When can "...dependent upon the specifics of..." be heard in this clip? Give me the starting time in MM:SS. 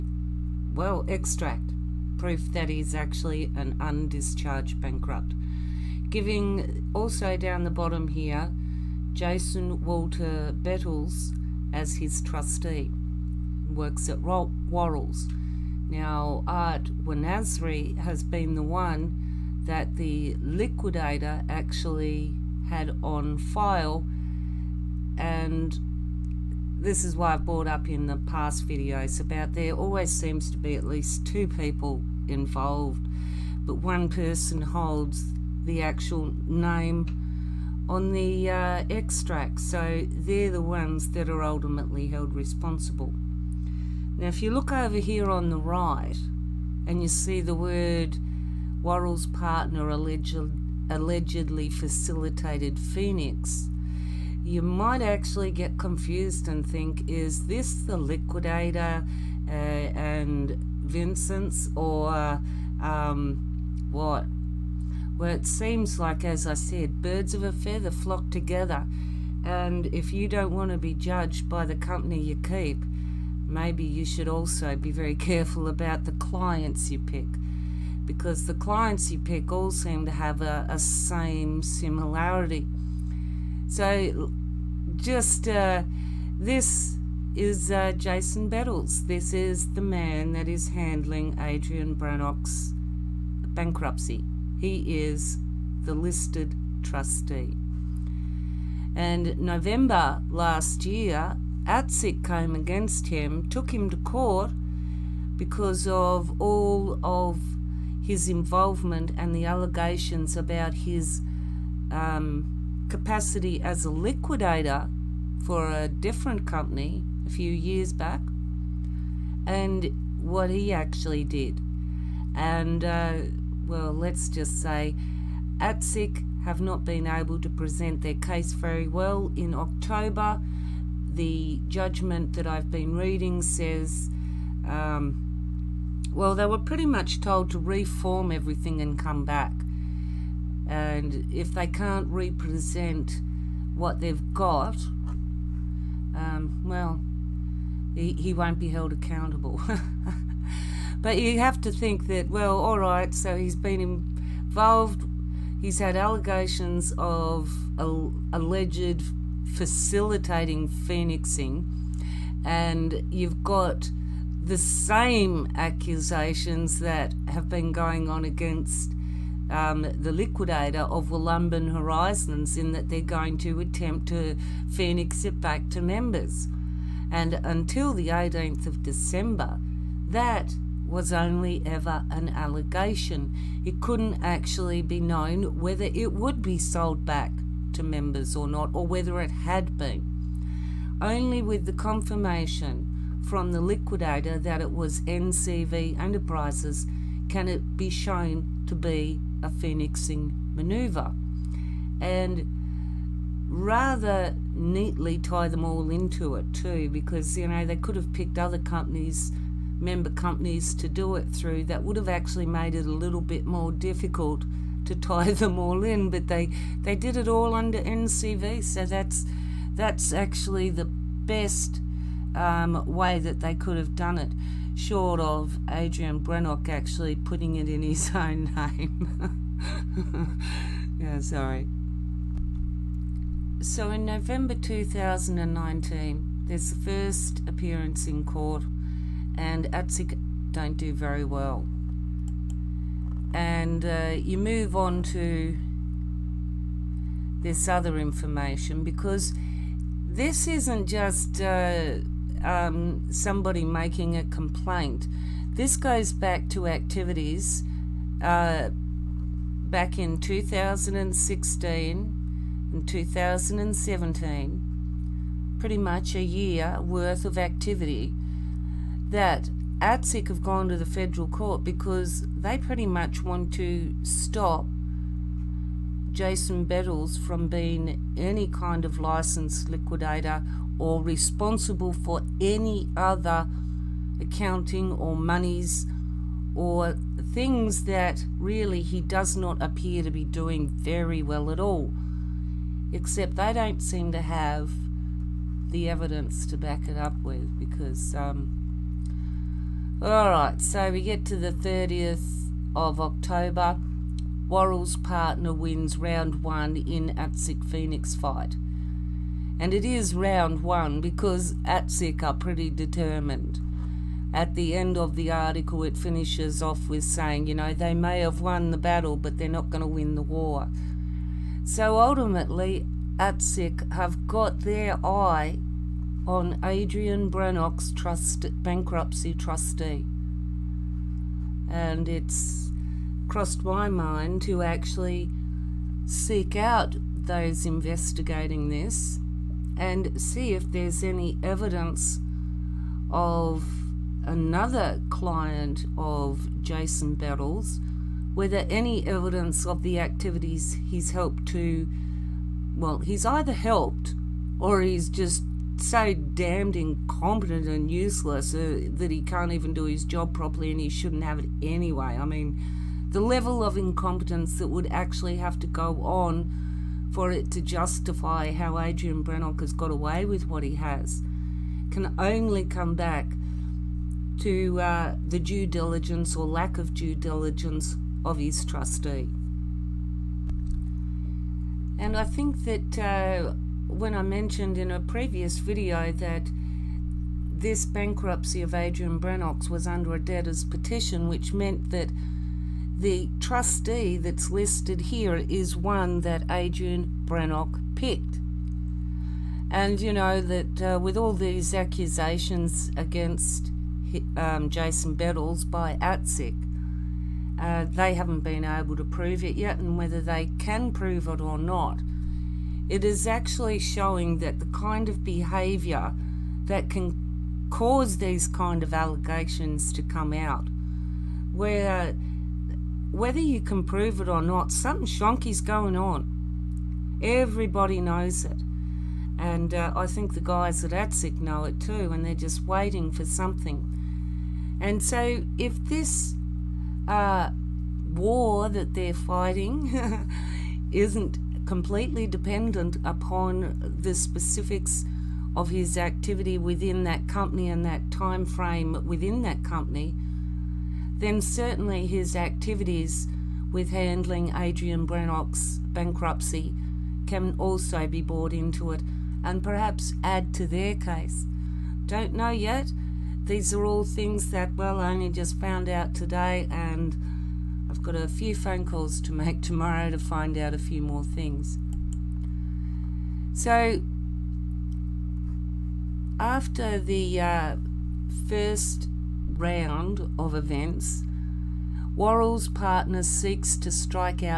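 07:22.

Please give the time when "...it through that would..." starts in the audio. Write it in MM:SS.
03:31.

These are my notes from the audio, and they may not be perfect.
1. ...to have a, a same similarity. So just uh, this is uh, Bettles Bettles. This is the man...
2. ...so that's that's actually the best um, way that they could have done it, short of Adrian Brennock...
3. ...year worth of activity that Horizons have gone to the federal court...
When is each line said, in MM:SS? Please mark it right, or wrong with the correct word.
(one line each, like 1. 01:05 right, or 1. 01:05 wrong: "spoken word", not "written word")
1. 01:20 wrong: "Jason", not "Bettles"
2. 03:38 right
3. 04:26 wrong: "ASIC", not "Horizons".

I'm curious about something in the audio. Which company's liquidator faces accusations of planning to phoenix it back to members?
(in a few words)
Wollumbin Horizons.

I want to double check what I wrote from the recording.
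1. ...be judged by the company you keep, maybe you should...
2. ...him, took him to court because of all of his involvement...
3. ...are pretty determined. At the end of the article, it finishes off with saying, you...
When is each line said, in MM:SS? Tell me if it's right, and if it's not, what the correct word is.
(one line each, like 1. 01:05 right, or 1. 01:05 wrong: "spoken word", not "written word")
1. 01:10 right
2. 01:43 right
3. 05:12 right.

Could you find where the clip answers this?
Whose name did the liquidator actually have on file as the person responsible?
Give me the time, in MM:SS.
00:16.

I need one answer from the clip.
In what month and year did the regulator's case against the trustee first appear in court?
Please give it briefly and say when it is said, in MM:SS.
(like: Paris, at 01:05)
November 2019, at 03:54.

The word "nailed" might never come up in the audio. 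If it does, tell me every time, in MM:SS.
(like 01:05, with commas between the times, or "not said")
not said.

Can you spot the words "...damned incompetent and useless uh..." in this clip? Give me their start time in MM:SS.
05:56.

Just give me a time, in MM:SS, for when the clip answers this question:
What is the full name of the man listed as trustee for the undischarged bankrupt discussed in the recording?
00:09.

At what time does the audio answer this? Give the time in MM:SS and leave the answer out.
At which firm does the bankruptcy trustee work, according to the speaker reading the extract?
00:14.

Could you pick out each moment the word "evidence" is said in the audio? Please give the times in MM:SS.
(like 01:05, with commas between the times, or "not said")
04:55, 05:41, 05:49.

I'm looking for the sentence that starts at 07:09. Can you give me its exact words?
And uh, I think the guys at ASIC know it too, and they're just waiting for something.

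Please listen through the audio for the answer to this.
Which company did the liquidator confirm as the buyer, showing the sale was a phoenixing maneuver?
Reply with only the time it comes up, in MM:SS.
03:15.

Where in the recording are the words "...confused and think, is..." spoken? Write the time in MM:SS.
00:55.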